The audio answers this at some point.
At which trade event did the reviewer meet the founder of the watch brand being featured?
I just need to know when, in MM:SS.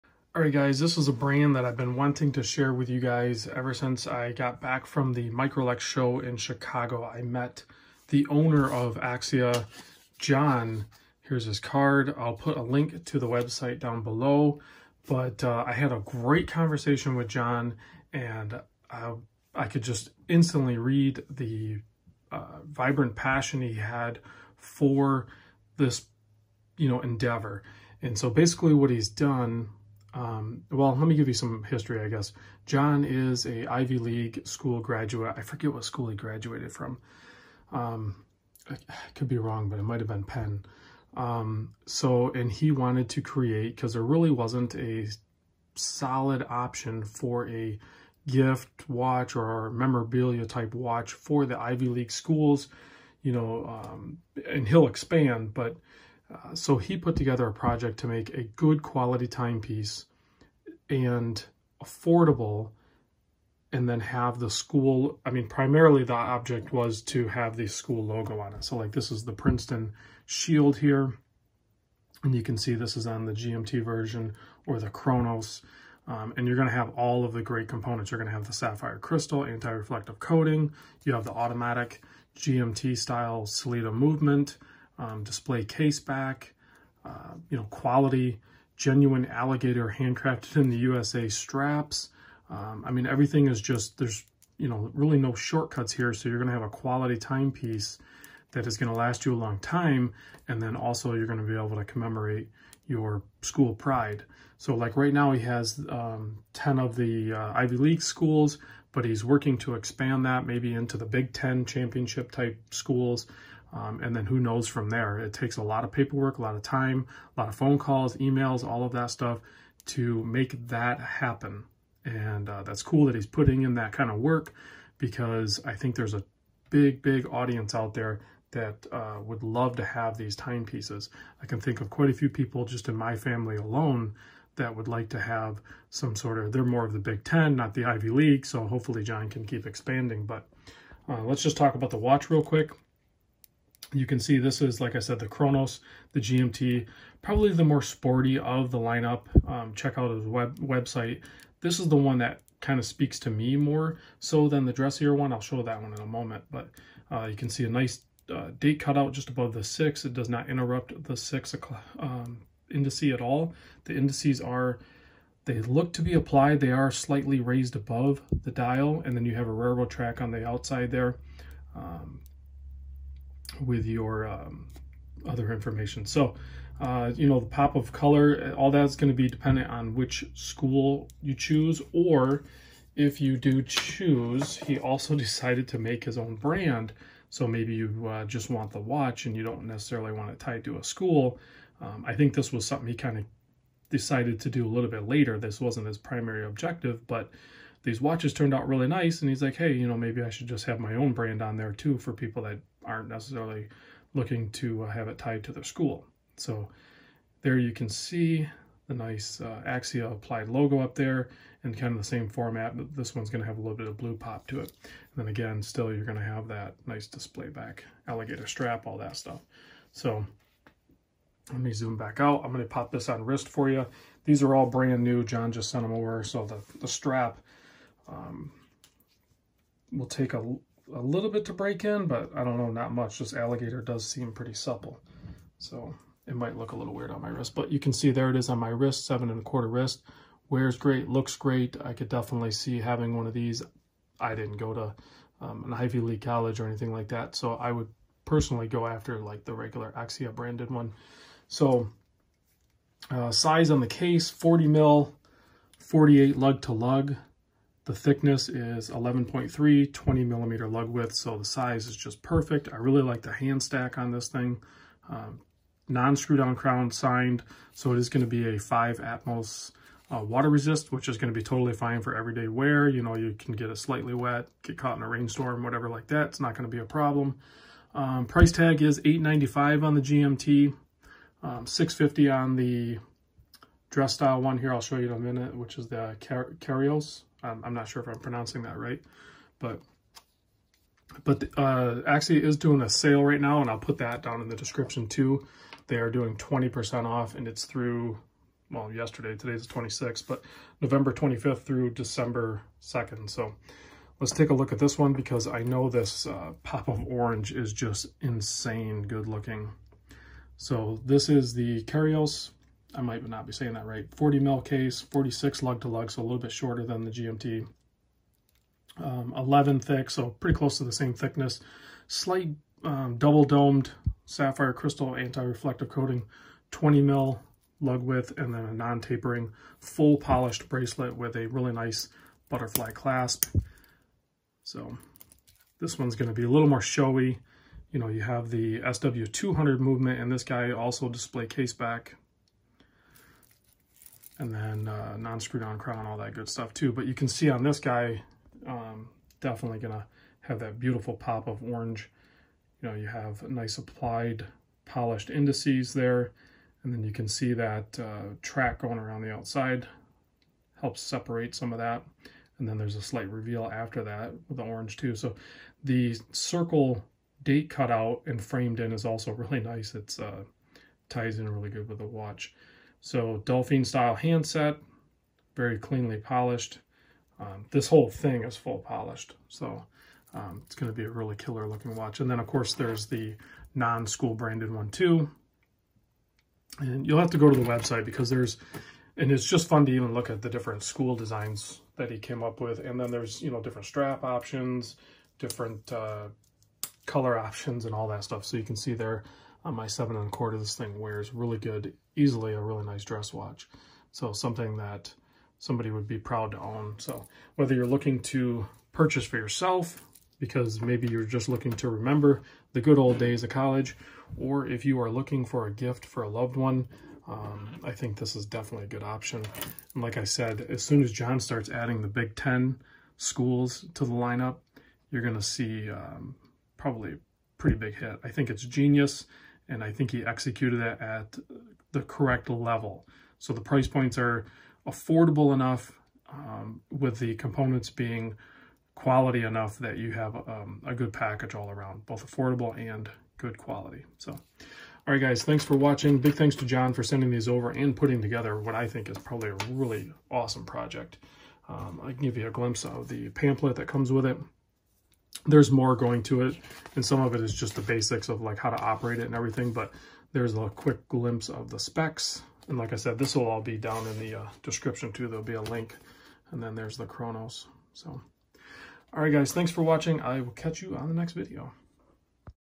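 00:05.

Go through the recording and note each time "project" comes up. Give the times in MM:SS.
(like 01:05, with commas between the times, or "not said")
00:57, 07:30.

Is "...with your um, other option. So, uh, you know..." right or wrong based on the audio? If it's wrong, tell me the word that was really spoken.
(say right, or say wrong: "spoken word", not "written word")
wrong: "information", not "option".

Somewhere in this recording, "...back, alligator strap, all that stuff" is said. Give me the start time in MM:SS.
03:37.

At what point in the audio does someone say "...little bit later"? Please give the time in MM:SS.
03:14.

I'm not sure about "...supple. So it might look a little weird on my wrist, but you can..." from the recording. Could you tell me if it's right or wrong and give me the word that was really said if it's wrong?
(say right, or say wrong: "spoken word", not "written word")
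right.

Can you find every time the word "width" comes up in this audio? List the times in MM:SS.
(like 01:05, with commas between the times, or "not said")
04:20, 05:28.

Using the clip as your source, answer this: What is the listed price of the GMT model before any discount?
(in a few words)
895.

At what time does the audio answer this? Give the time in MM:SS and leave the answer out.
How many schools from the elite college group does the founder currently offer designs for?
01:46.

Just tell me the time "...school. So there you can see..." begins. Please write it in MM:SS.
03:25.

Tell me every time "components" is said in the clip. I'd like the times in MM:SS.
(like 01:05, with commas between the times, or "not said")
01:17, 07:17.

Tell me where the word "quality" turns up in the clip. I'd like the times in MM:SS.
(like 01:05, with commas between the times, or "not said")
00:58, 01:27, 01:36, 07:18, 07:23.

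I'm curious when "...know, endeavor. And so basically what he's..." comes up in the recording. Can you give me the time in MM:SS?
00:26.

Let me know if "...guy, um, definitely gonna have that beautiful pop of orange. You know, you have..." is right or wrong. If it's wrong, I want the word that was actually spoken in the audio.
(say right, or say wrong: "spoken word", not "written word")
right.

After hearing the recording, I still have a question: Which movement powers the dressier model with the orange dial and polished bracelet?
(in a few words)
SW200.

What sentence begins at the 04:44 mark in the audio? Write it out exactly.
I'll show you in a minute, which is the Car Kairos.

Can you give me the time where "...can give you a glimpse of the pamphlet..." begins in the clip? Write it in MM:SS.
07:32.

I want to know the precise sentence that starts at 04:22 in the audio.
I really like the hand stack on this thing.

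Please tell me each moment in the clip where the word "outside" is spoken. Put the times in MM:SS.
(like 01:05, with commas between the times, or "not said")
02:50, 05:59.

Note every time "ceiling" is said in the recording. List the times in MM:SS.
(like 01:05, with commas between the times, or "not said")
not said.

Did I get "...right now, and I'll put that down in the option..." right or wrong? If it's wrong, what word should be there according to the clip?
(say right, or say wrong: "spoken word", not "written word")
wrong: "description", not "option".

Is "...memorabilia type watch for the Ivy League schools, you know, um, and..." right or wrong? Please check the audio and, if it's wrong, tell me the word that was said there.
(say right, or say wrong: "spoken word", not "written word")
right.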